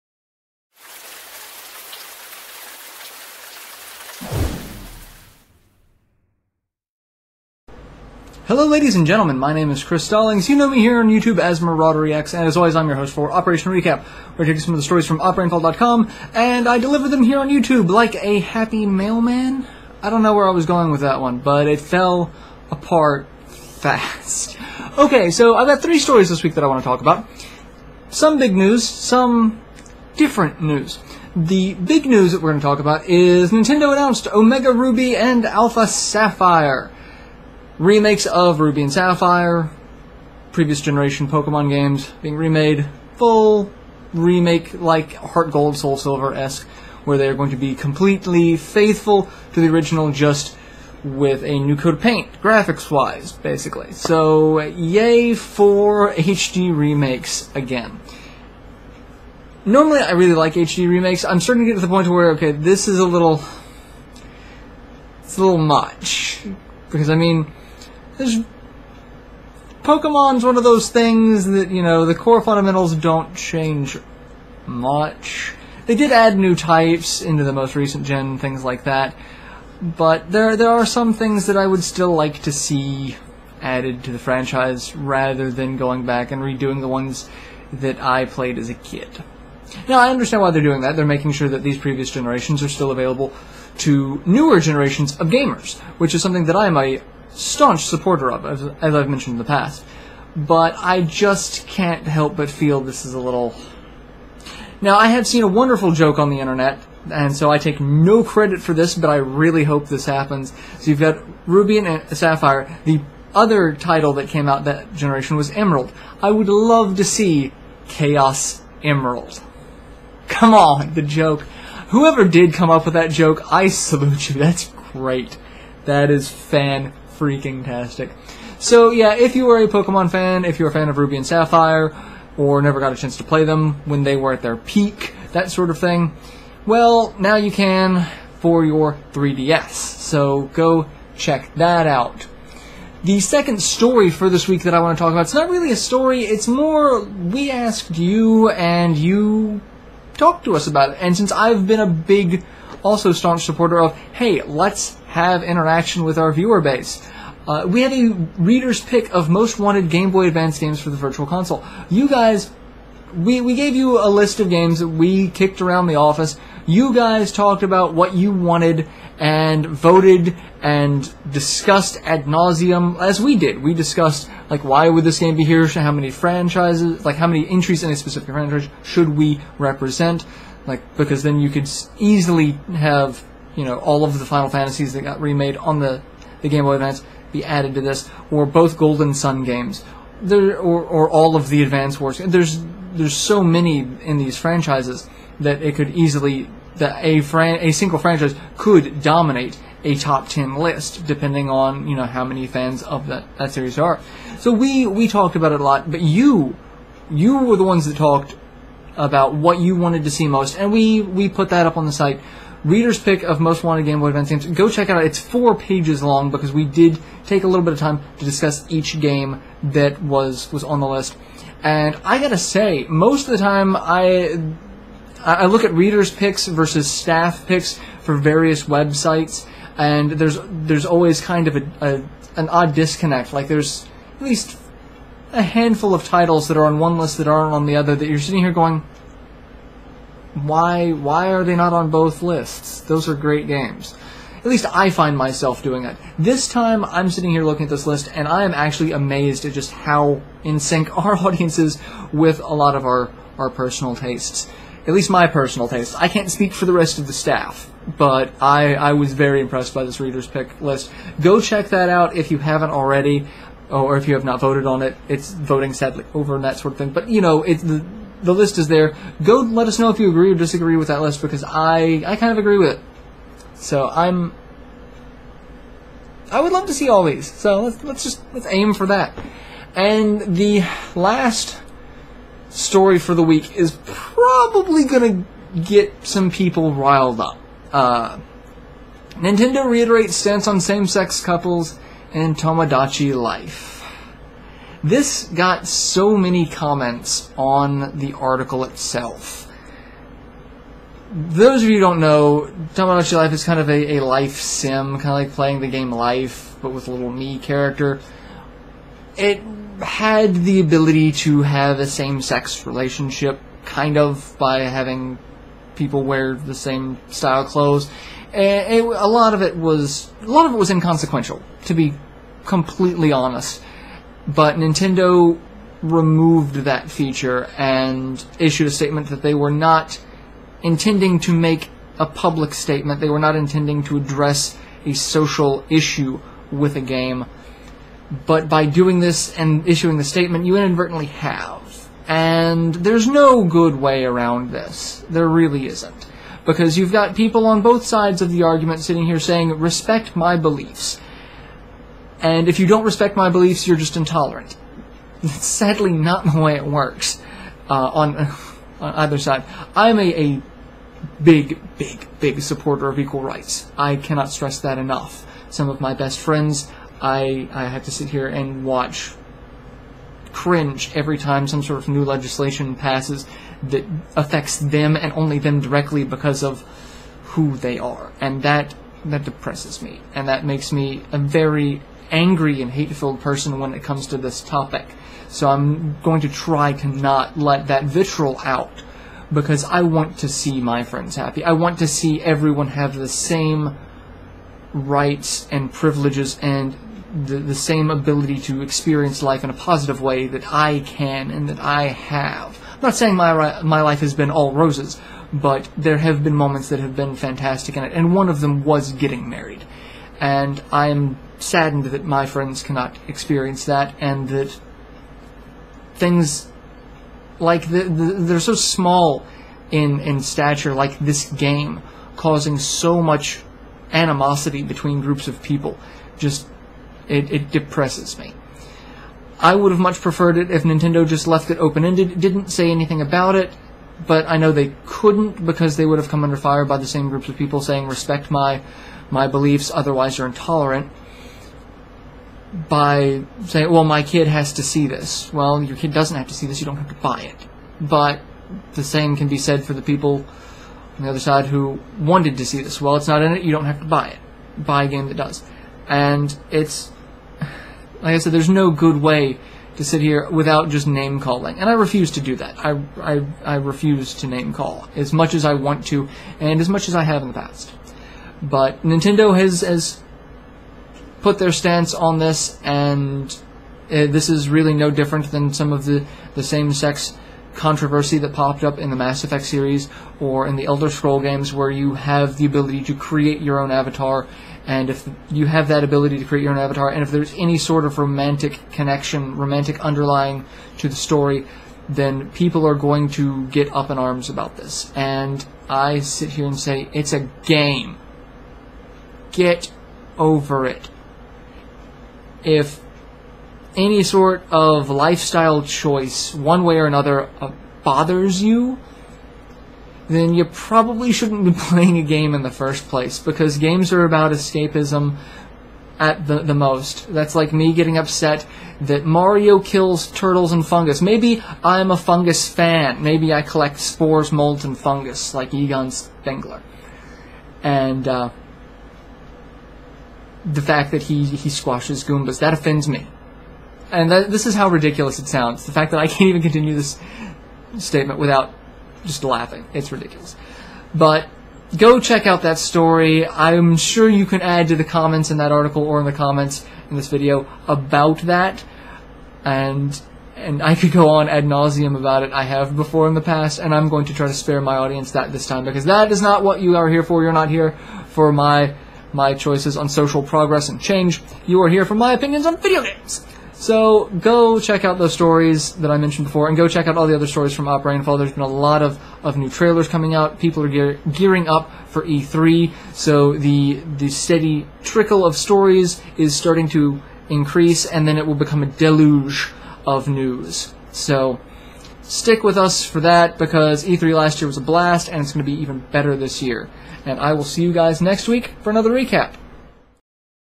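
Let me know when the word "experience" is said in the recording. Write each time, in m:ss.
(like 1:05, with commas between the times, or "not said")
6:38, 6:53.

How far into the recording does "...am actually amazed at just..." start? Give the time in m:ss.
4:08.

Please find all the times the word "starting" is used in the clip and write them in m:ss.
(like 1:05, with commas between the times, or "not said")
1:01, 9:36.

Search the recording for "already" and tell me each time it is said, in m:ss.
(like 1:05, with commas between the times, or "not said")
4:22.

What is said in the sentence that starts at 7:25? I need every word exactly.
Well, your kid doesn't have to see this, you don't have to buy it.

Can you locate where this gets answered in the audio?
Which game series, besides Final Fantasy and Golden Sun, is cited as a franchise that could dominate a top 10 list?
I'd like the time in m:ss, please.
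3:11.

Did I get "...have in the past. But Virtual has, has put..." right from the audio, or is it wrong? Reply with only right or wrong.
wrong.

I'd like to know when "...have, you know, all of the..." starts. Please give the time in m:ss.
3:02.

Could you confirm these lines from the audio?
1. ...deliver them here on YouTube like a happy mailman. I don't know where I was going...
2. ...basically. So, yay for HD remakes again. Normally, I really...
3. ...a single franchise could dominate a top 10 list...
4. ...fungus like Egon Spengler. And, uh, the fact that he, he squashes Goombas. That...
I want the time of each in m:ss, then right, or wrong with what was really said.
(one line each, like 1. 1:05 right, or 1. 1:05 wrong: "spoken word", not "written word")
1. 0:16 right
2. 0:53 right
3. 3:17 right
4. 8:44 right.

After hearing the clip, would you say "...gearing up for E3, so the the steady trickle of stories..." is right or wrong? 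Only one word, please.
right.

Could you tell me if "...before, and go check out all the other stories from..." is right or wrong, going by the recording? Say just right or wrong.
right.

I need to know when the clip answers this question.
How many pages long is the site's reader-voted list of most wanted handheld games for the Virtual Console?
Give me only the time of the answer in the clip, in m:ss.
3:35.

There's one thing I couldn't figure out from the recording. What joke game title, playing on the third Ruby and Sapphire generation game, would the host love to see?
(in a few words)
Chaos Emerald.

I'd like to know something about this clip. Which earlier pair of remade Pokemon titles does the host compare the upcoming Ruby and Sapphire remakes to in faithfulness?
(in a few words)
Heart Gold, Soul Silver.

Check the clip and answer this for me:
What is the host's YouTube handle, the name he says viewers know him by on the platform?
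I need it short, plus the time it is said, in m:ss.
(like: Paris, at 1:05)
Marauder, at 0:11.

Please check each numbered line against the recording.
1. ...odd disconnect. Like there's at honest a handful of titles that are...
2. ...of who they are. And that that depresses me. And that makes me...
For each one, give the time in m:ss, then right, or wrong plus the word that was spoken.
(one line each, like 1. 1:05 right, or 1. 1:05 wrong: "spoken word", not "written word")
1. 3:52 wrong: "least", not "honest"
2. 6:16 right.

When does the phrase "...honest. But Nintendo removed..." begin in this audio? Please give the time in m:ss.
5:23.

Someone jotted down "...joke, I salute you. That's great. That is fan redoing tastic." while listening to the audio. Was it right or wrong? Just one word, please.
wrong.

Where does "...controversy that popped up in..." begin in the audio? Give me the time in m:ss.
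7:57.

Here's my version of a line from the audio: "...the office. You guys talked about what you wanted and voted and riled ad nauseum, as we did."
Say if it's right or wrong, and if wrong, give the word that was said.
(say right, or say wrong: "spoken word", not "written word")
wrong: "discussed", not "riled".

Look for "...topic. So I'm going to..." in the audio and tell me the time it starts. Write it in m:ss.
6:24.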